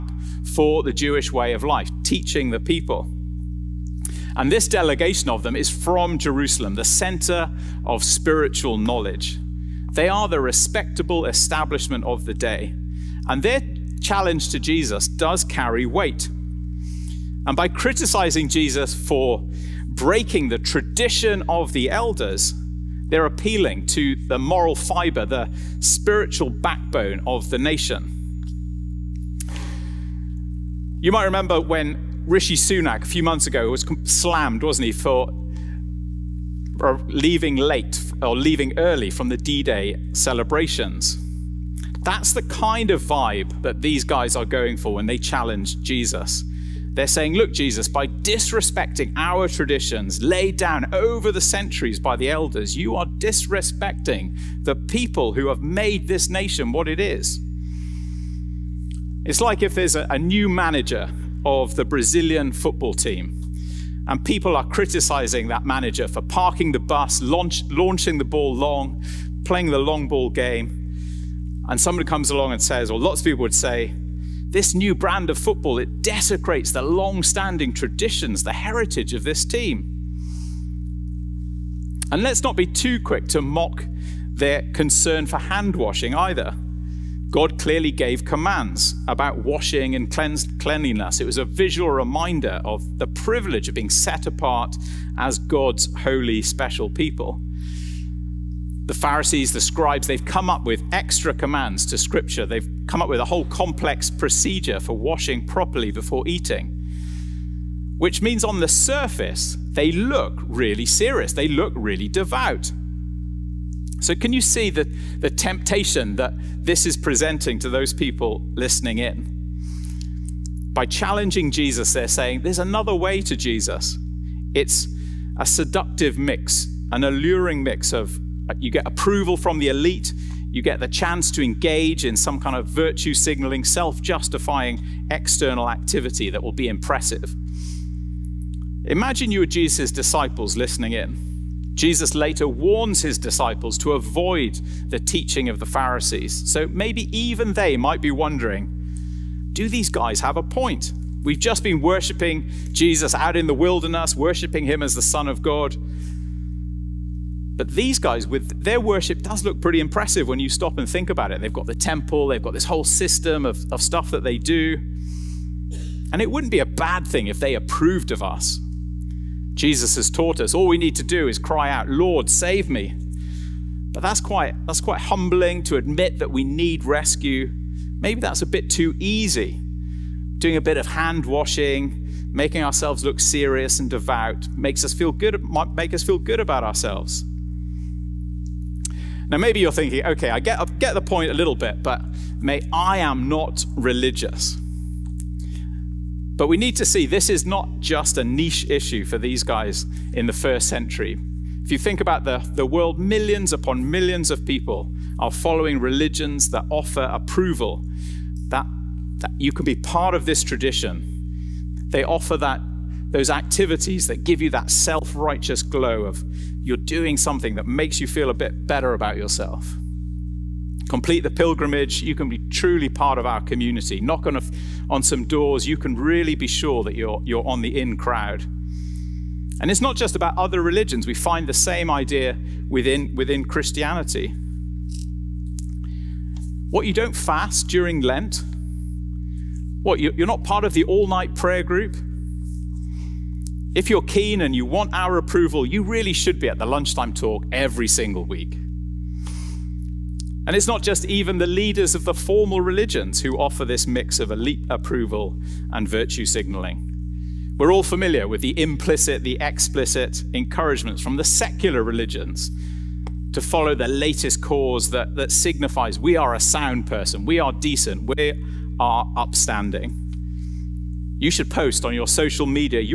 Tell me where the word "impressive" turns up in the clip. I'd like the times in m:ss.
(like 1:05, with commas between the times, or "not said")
2:16, 2:39.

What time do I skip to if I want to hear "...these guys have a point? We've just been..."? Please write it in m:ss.
2:29.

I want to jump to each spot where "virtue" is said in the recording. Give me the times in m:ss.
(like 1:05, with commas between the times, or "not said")
2:12, 4:15.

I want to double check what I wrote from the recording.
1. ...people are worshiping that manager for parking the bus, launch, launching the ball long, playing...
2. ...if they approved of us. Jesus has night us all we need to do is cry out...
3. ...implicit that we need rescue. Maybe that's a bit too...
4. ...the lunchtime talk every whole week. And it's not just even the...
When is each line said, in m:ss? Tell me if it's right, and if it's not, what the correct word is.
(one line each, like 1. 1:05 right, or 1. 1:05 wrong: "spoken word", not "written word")
1. 1:04 wrong: "criticizing", not "worshiping"
2. 2:47 wrong: "taught", not "night"
3. 2:55 wrong: "admit", not "implicit"
4. 4:06 wrong: "single", not "whole".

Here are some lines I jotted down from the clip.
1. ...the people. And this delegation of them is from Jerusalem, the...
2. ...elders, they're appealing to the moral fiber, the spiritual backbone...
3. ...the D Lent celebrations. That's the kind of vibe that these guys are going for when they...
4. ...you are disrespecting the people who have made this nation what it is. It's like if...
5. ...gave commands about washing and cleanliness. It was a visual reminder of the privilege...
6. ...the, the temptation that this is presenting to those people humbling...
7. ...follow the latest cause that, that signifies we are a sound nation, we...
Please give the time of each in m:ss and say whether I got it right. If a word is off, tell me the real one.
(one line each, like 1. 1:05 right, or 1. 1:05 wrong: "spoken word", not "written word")
1. 0:02 right
2. 0:21 right
3. 0:39 wrong: "Day", not "Lent"
4. 0:52 right
5. 1:27 right
6. 1:54 wrong: "listening", not "humbling"
7. 4:23 wrong: "person", not "nation".